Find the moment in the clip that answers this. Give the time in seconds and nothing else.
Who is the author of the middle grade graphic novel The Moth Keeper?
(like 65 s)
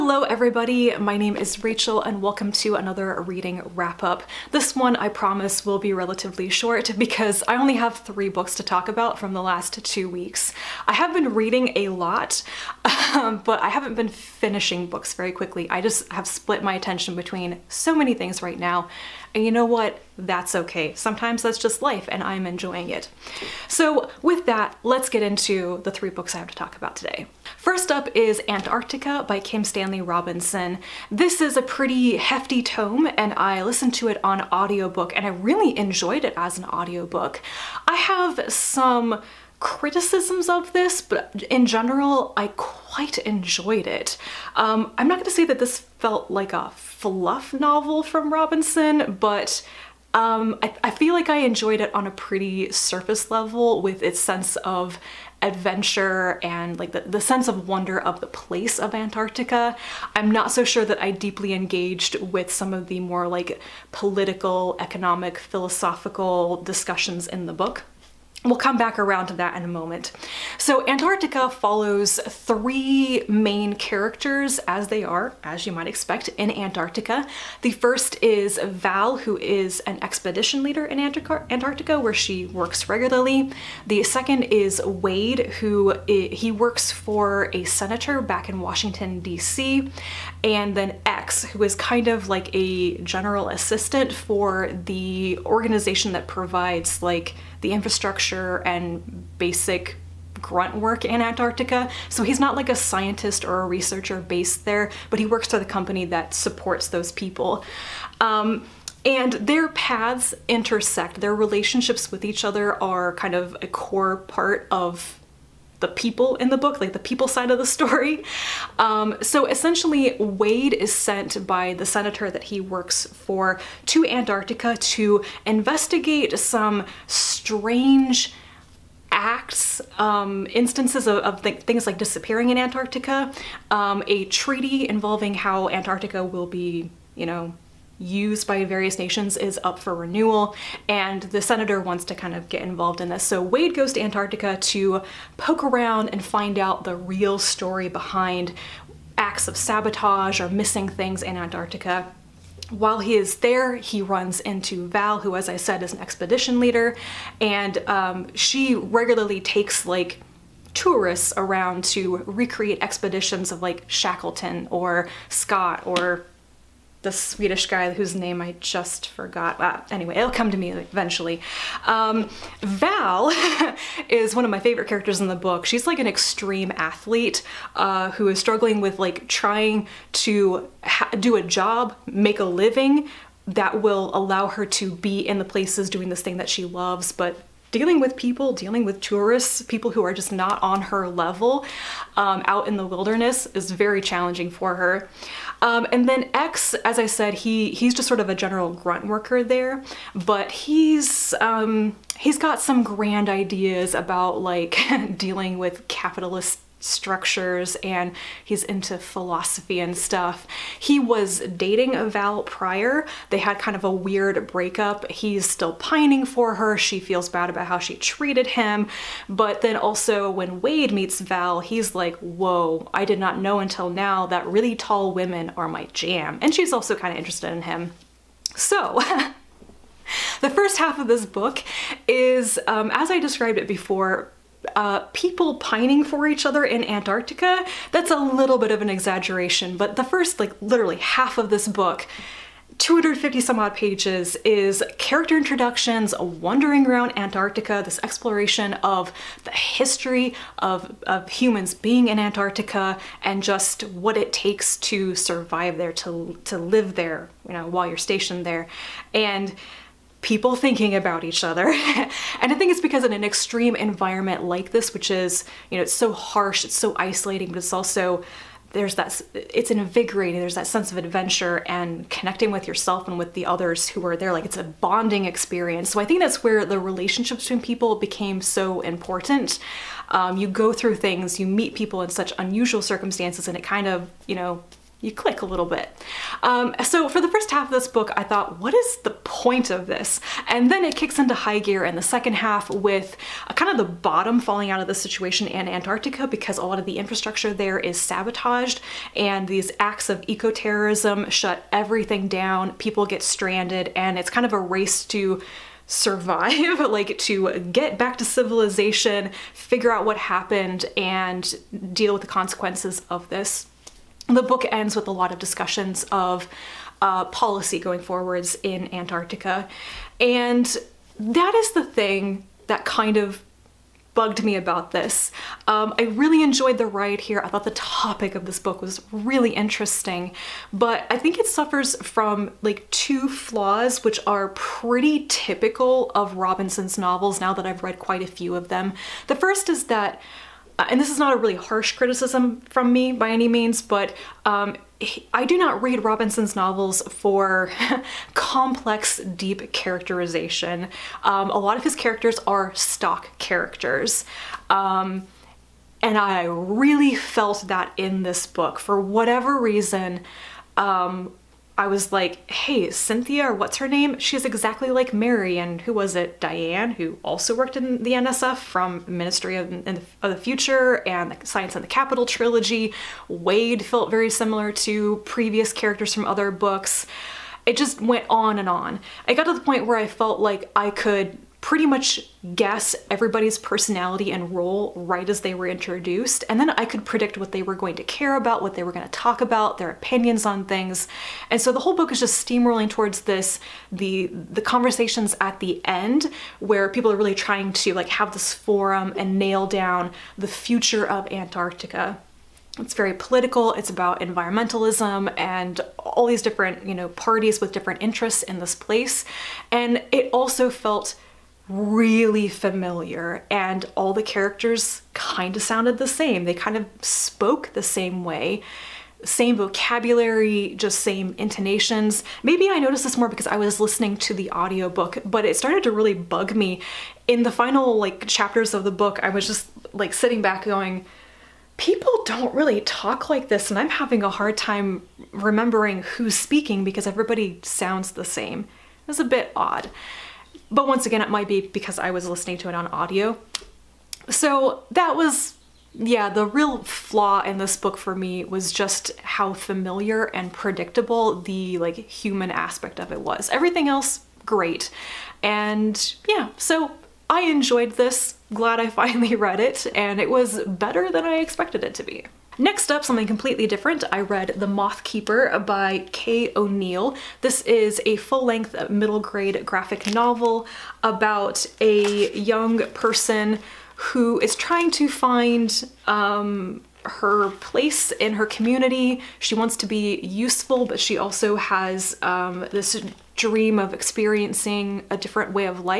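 466 s.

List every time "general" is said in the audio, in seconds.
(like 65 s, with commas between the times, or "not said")
41 s, 92 s, 198 s.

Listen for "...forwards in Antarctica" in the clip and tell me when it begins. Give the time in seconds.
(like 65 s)
318 s.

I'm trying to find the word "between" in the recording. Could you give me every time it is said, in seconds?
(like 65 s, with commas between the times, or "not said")
17 s, 277 s.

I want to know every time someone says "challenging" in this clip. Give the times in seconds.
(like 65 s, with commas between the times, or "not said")
194 s.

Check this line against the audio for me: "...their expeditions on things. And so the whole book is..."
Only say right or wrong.
wrong.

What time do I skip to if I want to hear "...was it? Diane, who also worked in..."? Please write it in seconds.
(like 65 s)
365 s.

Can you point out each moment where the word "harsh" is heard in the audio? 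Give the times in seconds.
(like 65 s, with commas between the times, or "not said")
266 s, 341 s.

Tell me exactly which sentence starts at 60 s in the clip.
I'm not so sure that I deeply engaged with some of the more like political, economic, philosophical discussions in the book.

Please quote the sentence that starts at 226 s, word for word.
And she's also kind of interested in him.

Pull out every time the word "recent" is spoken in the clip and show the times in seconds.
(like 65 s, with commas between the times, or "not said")
not said.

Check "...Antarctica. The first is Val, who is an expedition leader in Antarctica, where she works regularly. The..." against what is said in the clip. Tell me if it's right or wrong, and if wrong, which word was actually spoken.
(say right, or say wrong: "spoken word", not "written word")
right.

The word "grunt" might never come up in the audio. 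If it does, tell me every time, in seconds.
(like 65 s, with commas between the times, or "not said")
100 s, 198 s.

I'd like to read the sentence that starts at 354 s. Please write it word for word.
Um, and I really felt that in this book.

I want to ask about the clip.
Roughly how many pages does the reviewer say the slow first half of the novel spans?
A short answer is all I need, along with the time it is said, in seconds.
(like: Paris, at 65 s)
250, at 242 s.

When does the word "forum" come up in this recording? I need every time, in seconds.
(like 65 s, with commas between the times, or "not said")
398 s.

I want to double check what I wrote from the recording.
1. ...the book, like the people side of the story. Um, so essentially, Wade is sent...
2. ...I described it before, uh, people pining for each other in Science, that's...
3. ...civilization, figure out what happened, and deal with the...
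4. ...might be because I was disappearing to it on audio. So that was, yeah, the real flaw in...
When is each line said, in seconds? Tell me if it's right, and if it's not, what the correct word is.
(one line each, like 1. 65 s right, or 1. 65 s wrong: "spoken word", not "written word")
1. 116 s right
2. 233 s wrong: "Antarctica", not "Science"
3. 308 s right
4. 441 s wrong: "listening", not "disappearing".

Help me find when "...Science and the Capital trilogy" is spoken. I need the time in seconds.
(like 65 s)
371 s.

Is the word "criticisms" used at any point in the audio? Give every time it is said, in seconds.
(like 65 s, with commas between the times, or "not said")
39 s, 341 s.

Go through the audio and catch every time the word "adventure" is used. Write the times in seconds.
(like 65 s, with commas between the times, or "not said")
55 s, 270 s.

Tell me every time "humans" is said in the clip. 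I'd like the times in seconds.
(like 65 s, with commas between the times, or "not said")
251 s, 451 s.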